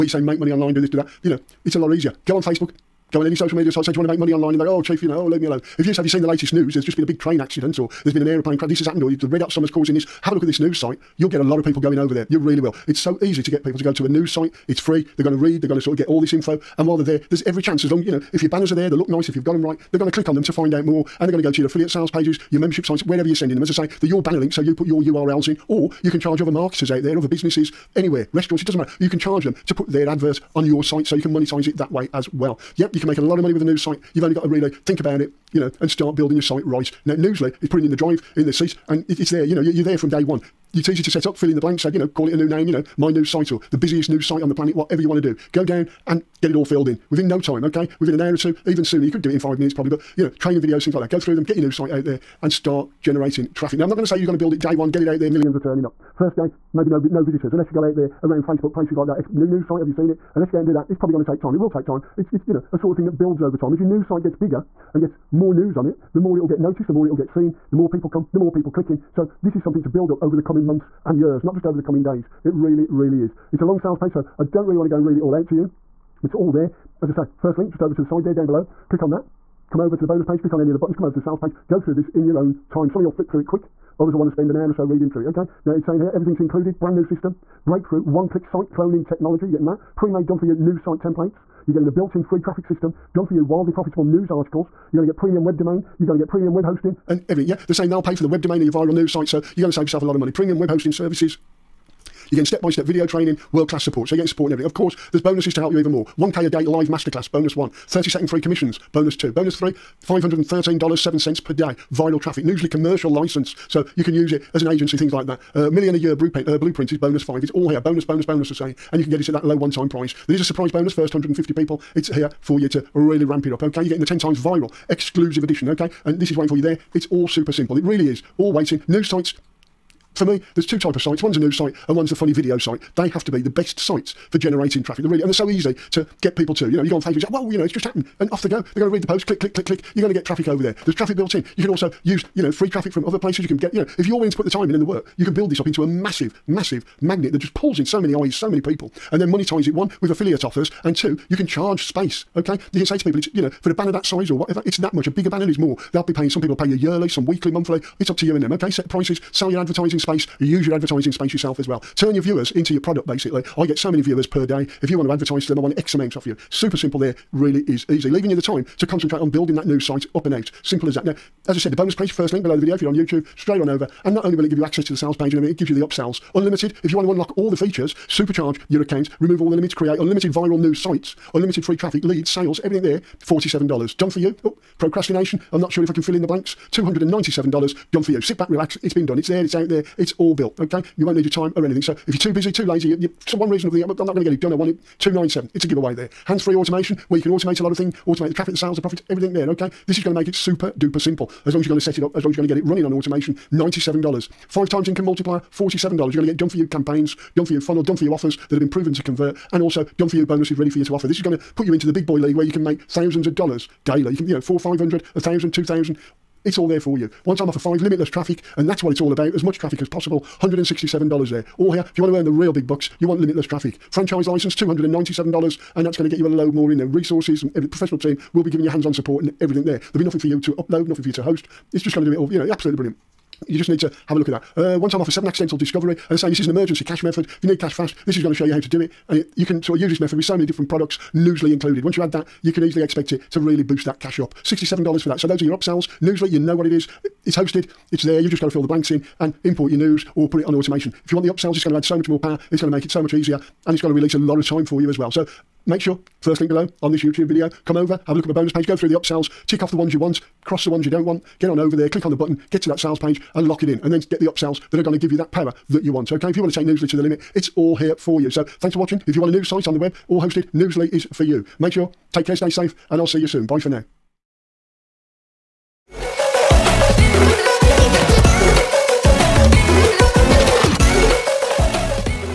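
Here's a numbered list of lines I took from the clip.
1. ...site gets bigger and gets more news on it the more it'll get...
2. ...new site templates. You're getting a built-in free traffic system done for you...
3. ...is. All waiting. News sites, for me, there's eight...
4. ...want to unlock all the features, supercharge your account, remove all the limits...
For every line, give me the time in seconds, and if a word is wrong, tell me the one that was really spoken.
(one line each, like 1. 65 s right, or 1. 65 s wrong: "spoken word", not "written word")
1. 64 s right
2. 90 s right
3. 128 s wrong: "two", not "eight"
4. 176 s right.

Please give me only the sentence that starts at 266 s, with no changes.
Okay, if you want to take Newsly to the limit, it's all here for you.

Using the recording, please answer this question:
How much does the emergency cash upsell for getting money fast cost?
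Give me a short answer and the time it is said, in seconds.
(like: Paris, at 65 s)
$67, at 244 s.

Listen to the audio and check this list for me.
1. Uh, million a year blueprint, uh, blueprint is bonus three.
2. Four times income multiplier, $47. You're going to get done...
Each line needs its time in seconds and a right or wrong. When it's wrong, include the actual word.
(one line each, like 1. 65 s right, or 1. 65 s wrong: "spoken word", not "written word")
1. 115 s wrong: "five", not "three"
2. 204 s wrong: "Five", not "Four".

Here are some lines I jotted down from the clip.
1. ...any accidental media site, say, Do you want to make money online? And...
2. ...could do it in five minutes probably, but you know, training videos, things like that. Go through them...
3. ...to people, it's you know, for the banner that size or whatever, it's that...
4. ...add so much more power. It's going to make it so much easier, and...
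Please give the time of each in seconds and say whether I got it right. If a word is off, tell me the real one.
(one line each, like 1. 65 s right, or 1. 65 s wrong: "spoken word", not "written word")
1. 3 s wrong: "social", not "accidental"
2. 49 s right
3. 152 s right
4. 251 s right.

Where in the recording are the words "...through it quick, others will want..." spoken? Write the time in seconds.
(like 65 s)
83 s.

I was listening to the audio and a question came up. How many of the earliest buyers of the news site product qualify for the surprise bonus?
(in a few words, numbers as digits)
150.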